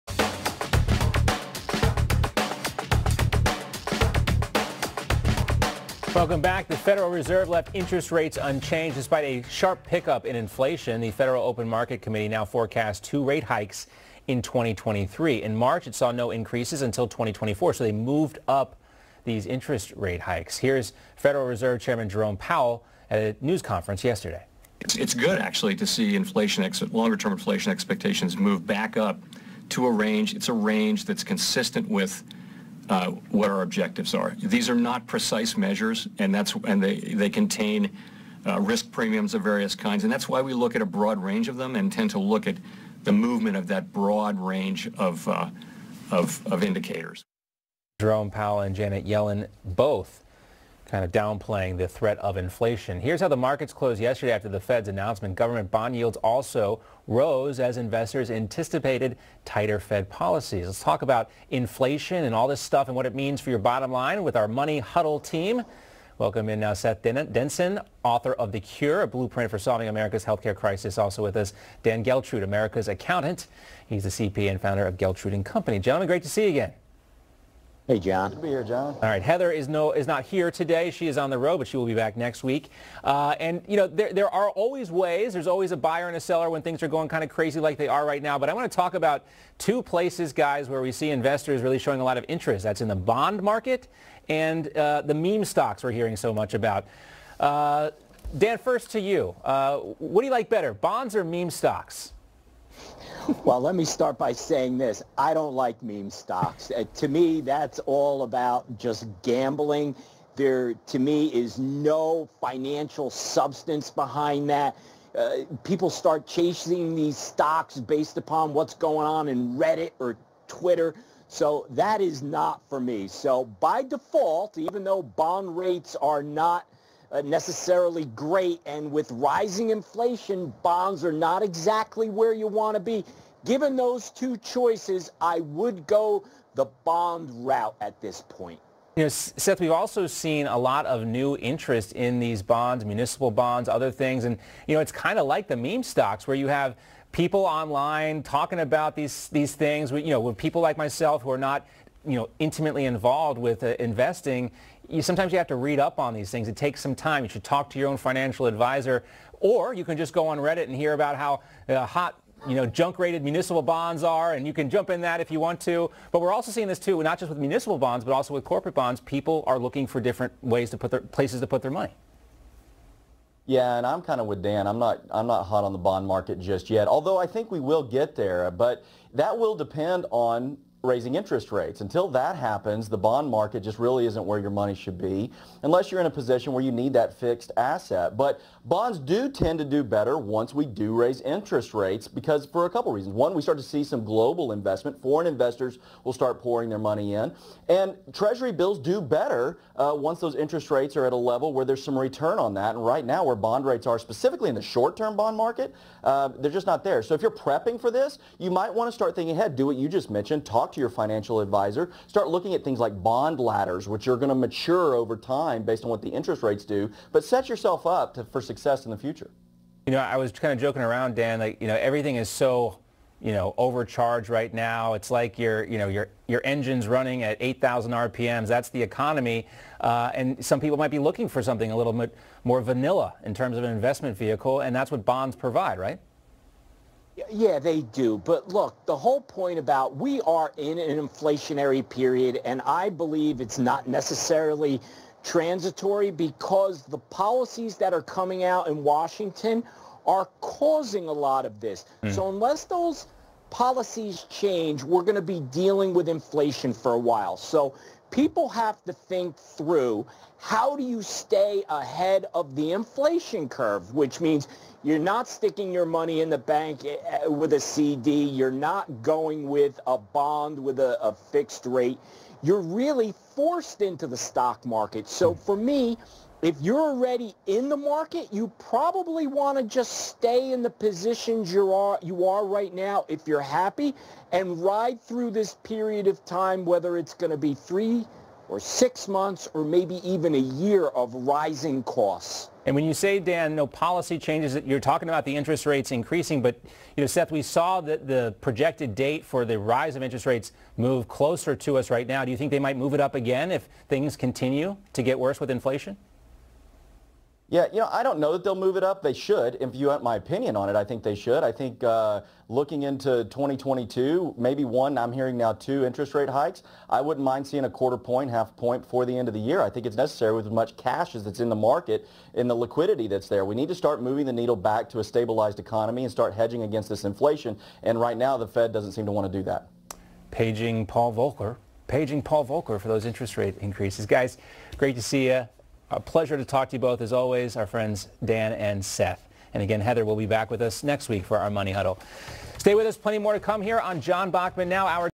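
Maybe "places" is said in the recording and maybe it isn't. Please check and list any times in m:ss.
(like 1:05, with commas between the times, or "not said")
1:29, 2:51.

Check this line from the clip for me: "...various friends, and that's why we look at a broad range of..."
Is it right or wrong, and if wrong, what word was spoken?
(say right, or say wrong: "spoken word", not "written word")
wrong: "kinds", not "friends".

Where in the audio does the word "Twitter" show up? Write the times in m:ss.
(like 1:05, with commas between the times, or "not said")
2:00.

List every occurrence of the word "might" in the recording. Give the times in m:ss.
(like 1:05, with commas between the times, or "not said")
3:28, 3:50, 5:02.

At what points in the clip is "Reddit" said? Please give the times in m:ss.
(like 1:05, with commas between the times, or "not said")
1:59, 2:40.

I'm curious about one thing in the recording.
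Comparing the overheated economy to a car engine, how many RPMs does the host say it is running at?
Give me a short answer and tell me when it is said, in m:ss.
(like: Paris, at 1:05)
8,000, at 3:47.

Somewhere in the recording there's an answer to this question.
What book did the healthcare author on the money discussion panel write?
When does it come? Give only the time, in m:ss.
1:08.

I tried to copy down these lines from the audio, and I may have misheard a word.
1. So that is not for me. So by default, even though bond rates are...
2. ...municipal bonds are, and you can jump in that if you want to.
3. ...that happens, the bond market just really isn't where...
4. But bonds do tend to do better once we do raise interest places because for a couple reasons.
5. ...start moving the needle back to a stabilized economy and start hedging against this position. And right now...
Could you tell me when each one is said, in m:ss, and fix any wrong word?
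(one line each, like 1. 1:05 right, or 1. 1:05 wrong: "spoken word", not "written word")
1. 2:01 right
2. 2:43 right
3. 3:02 right
4. 3:08 wrong: "rates", not "places"
5. 5:23 wrong: "inflation", not "position".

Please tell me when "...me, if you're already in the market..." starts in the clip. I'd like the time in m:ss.
4:35.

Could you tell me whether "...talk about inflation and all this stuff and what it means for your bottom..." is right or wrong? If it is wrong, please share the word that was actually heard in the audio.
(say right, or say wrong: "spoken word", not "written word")
right.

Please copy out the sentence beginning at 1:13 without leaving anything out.
He's the CPA and founder of Geltrude & Company.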